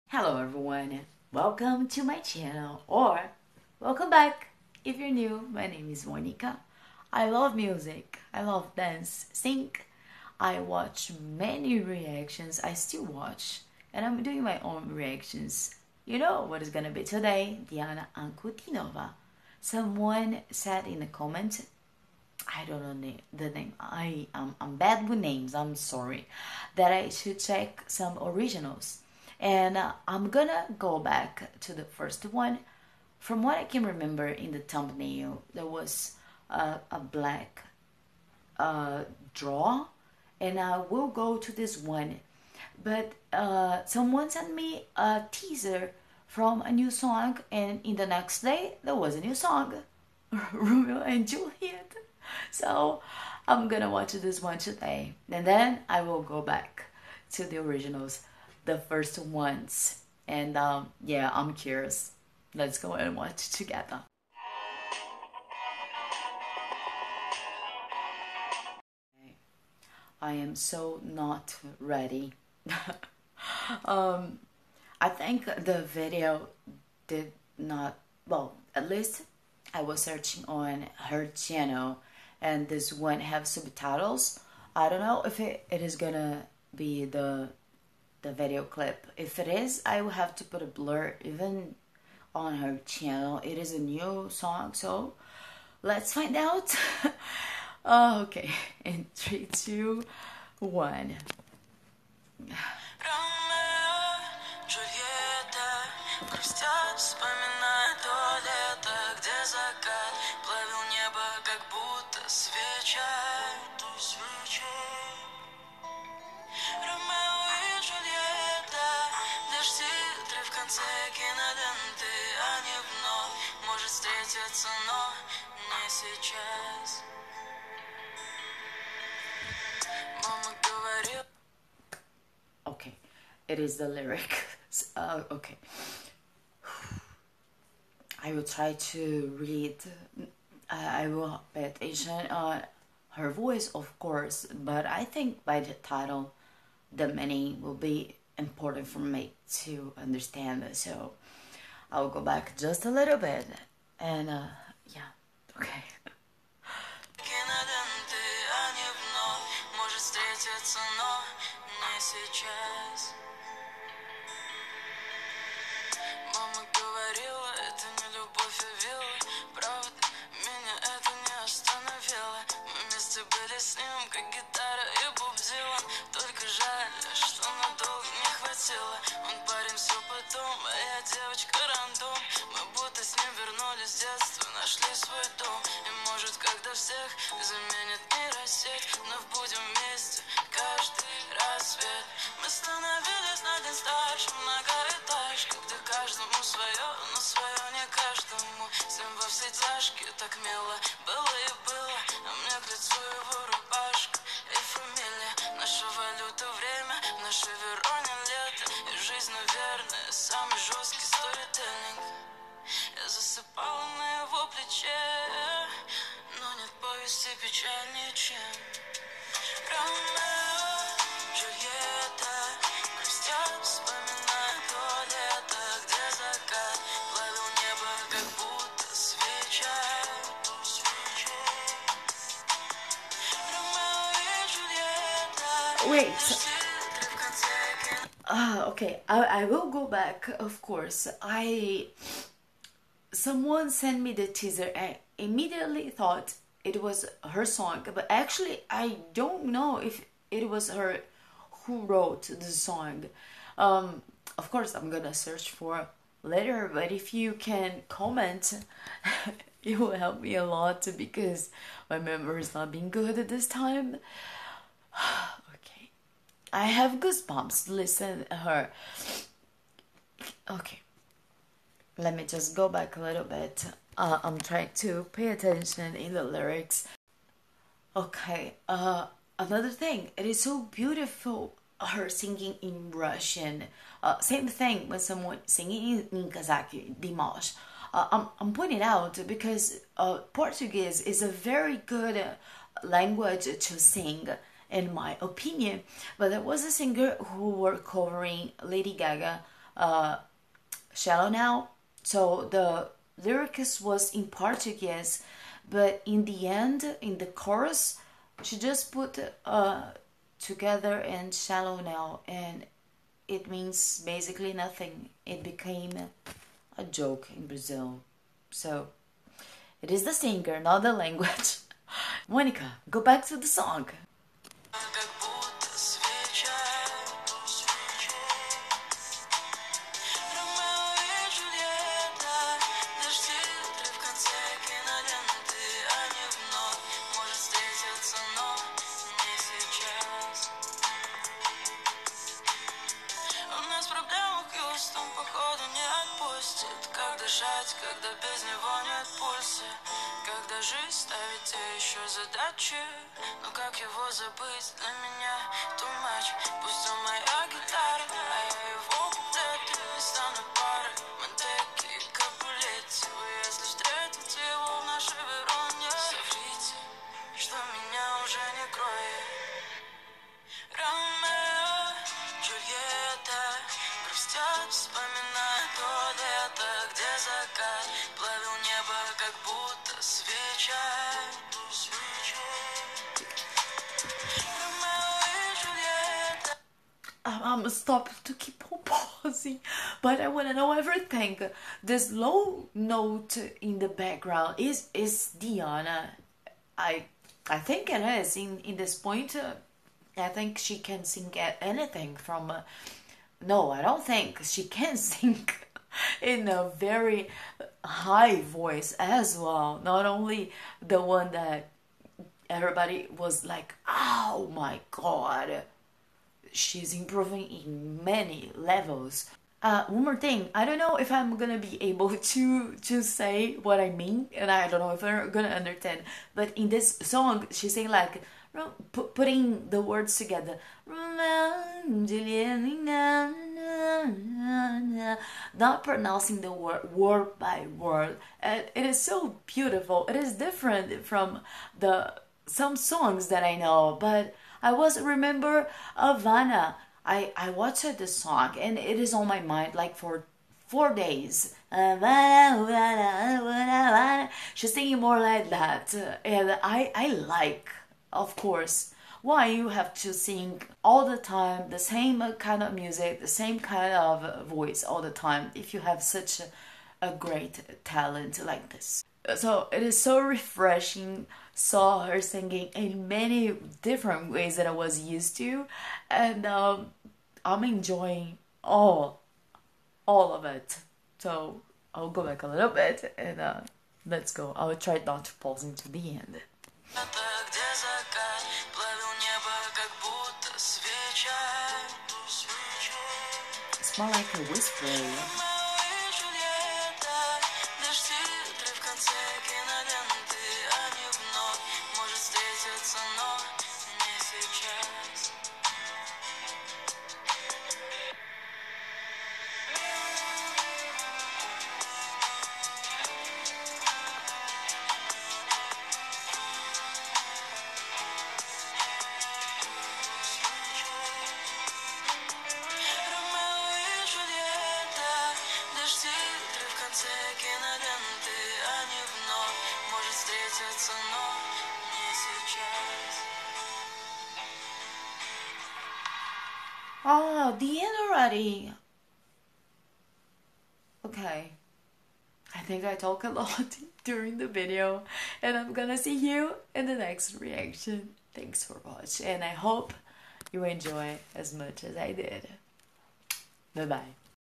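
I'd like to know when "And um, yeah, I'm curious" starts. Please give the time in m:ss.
1:00.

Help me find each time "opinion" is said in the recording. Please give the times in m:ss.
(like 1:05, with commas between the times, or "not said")
4:55.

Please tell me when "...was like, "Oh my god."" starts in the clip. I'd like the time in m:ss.
6:53.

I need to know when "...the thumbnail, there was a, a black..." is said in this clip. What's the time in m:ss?
0:34.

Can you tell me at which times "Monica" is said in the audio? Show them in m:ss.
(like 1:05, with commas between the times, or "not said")
0:06, 5:22.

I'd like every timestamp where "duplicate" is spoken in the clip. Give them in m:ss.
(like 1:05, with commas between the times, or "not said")
not said.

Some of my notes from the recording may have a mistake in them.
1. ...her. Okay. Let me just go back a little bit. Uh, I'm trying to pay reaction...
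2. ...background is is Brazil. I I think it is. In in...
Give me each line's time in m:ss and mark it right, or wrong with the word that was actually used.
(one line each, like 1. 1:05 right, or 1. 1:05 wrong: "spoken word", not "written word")
1. 4:28 wrong: "attention", not "reaction"
2. 6:33 wrong: "Diana", not "Brazil".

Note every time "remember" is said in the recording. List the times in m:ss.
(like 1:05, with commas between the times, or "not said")
0:33, 7:25.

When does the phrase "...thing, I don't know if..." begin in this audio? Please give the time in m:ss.
7:00.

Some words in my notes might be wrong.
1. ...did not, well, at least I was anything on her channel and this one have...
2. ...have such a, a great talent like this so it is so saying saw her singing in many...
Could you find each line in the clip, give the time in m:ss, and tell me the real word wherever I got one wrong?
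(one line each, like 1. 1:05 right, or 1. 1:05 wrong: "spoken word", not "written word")
1. 1:17 wrong: "searching", not "anything"
2. 7:45 wrong: "refreshing", not "saying".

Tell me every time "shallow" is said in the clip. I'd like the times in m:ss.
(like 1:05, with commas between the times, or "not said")
5:00, 5:11.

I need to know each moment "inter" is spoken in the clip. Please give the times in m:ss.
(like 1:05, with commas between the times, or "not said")
not said.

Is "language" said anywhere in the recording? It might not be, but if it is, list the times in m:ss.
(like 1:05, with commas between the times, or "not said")
4:52, 5:20.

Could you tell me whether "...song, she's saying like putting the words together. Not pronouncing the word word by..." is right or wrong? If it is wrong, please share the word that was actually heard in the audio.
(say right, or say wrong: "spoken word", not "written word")
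right.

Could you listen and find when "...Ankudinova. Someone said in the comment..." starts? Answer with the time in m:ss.
0:18.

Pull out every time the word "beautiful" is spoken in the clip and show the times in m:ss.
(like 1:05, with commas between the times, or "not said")
4:40, 7:19.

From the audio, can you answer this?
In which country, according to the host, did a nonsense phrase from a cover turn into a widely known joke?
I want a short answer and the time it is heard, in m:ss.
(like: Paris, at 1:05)
Brazil, at 5:17.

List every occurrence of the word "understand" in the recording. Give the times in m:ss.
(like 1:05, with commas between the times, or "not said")
2:29, 7:05.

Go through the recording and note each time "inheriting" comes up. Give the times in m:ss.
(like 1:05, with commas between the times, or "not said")
not said.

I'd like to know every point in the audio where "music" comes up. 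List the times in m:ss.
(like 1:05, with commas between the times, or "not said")
0:07, 7:42.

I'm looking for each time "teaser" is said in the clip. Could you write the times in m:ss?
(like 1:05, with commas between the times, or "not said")
0:45, 4:04.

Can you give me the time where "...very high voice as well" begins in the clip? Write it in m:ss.
6:46.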